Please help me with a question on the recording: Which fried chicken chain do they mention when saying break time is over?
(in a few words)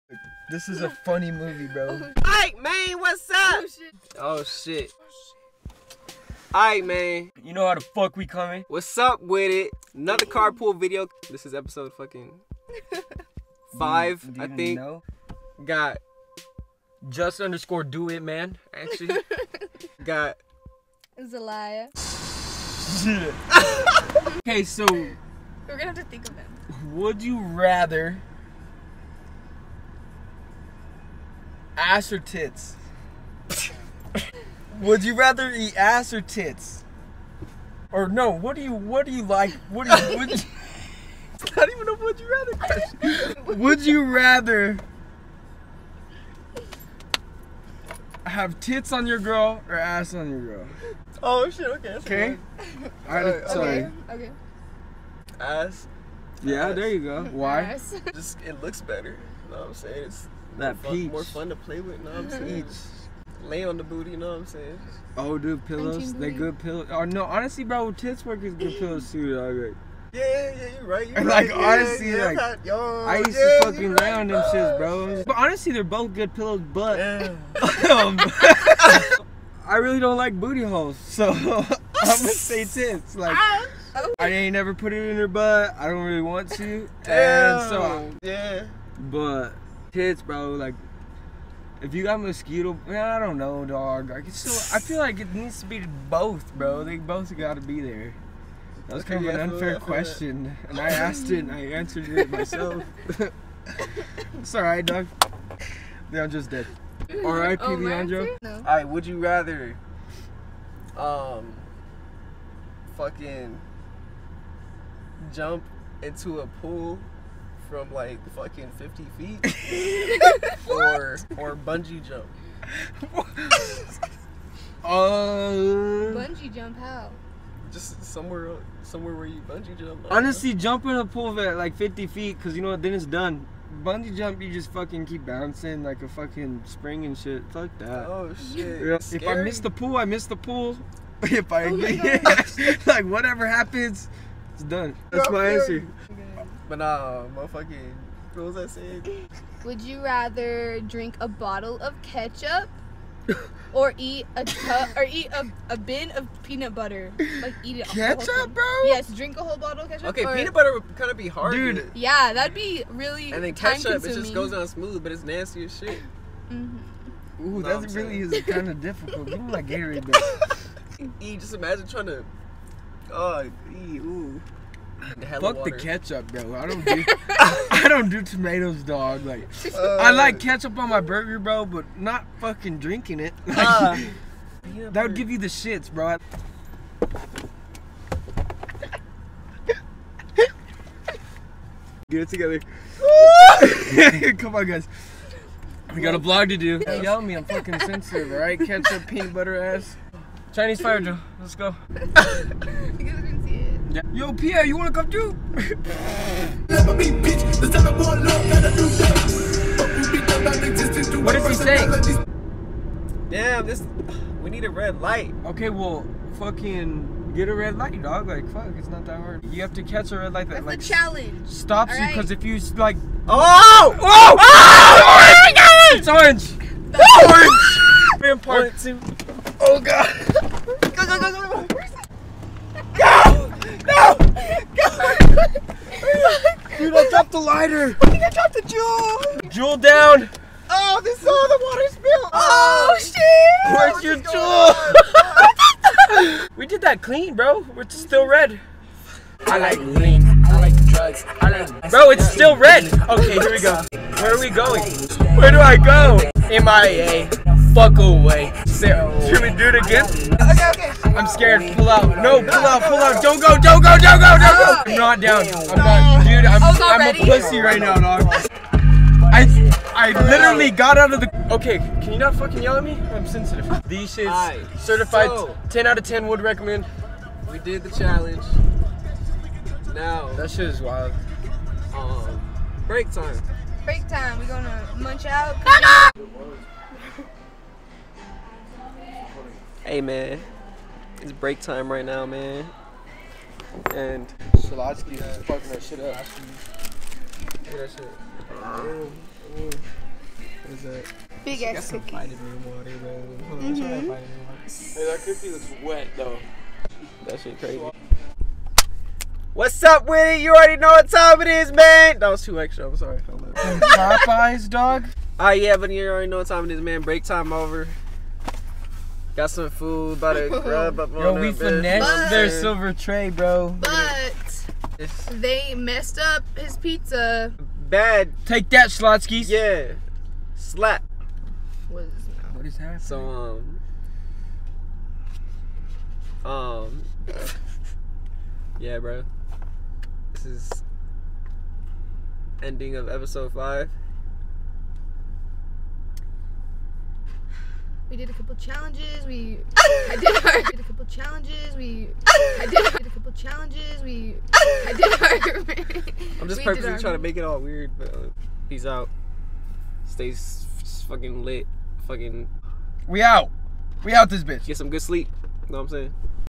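Popeyes.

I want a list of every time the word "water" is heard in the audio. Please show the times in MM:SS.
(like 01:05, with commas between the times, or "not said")
04:01, 05:02.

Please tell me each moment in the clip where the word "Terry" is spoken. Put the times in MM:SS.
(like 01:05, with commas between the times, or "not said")
not said.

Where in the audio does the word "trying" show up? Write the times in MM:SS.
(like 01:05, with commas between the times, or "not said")
02:51, 05:56.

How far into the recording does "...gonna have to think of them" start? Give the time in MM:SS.
00:25.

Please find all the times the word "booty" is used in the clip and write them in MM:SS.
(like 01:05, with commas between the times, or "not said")
01:03, 01:20.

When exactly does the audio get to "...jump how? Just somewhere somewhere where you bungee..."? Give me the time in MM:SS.
02:06.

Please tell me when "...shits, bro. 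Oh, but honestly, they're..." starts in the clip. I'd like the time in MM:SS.
01:14.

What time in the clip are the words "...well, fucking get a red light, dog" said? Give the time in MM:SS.
03:35.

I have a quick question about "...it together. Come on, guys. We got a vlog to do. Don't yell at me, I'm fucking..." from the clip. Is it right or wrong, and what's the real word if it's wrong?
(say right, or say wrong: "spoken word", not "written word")
right.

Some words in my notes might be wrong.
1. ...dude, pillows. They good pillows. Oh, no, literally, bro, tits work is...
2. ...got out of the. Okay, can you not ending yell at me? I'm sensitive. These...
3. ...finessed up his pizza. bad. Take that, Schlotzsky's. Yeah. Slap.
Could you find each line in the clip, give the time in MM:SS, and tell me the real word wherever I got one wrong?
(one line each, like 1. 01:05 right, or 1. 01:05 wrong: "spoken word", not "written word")
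1. 01:05 wrong: "honestly", not "literally"
2. 04:30 wrong: "fucking", not "ending"
3. 05:25 wrong: "messed", not "finessed".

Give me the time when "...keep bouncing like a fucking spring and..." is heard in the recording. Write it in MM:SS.
02:15.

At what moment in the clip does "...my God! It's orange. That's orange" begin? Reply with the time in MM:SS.
03:45.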